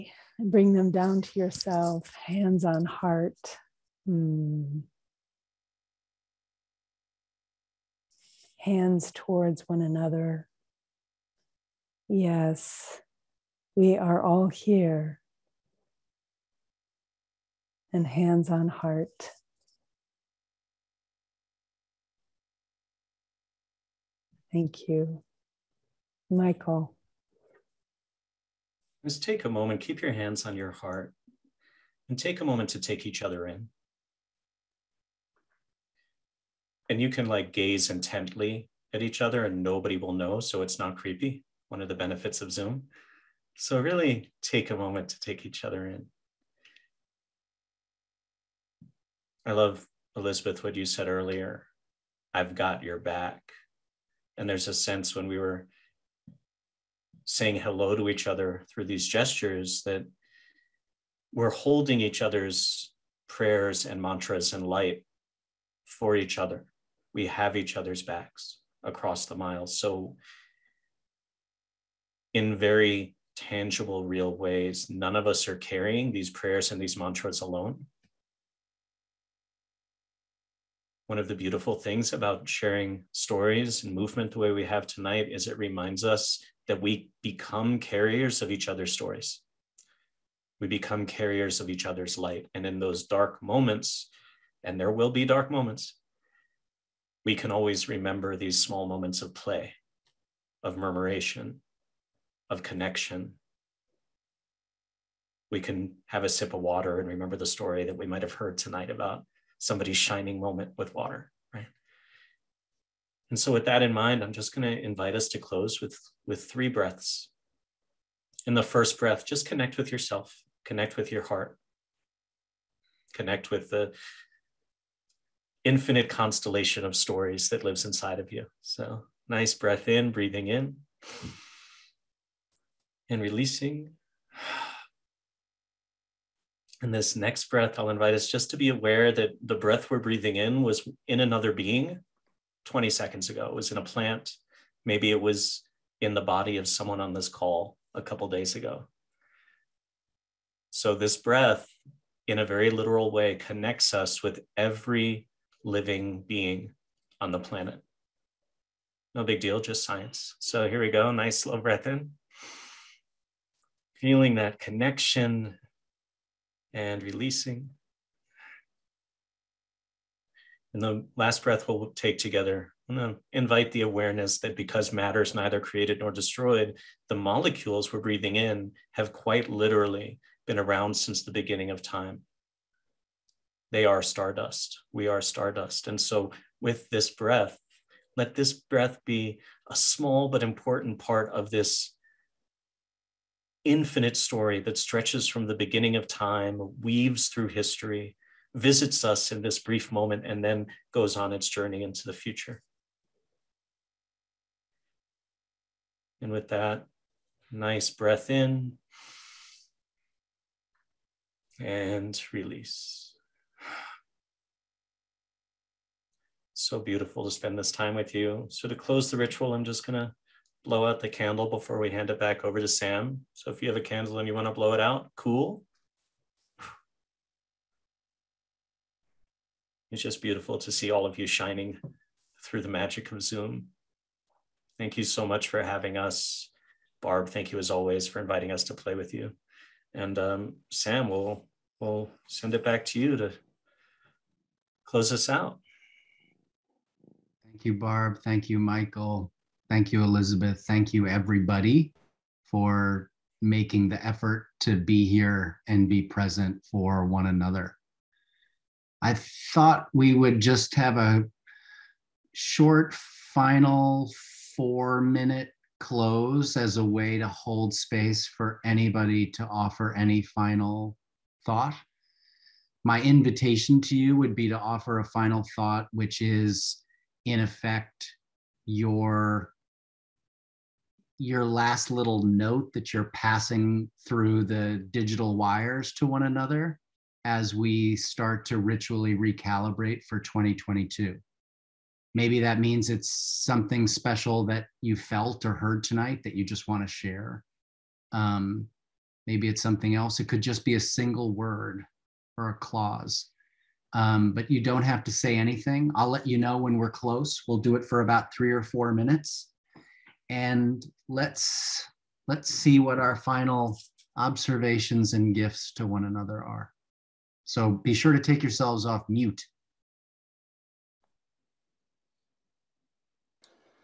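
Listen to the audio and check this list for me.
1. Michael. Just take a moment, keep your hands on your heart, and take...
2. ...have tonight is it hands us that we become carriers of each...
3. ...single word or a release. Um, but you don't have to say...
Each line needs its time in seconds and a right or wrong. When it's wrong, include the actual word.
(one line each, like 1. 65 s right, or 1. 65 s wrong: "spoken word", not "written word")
1. 26 s right
2. 84 s wrong: "reminds", not "hands"
3. 300 s wrong: "clause", not "release".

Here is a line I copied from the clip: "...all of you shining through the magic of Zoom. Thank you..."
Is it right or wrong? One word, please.
right.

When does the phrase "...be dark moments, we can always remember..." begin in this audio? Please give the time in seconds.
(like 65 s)
95 s.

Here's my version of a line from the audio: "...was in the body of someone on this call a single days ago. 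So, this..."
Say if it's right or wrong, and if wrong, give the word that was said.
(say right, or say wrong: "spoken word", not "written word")
wrong: "couple", not "single".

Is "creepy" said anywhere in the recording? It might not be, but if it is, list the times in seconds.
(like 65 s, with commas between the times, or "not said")
40 s.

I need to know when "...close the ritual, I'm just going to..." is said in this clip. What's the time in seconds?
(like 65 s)
218 s.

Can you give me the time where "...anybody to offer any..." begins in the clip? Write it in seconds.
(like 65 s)
268 s.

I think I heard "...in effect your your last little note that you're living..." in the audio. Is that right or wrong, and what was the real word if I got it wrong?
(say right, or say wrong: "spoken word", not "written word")
wrong: "passing", not "living".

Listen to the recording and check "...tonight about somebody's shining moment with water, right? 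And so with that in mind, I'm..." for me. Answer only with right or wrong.
right.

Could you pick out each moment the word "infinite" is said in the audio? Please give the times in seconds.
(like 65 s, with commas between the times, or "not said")
125 s, 193 s.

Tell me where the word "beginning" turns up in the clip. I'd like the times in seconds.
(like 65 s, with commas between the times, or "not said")
181 s, 195 s.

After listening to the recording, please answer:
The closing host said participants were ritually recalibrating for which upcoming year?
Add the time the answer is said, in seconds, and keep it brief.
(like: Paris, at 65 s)
2022, at 290 s.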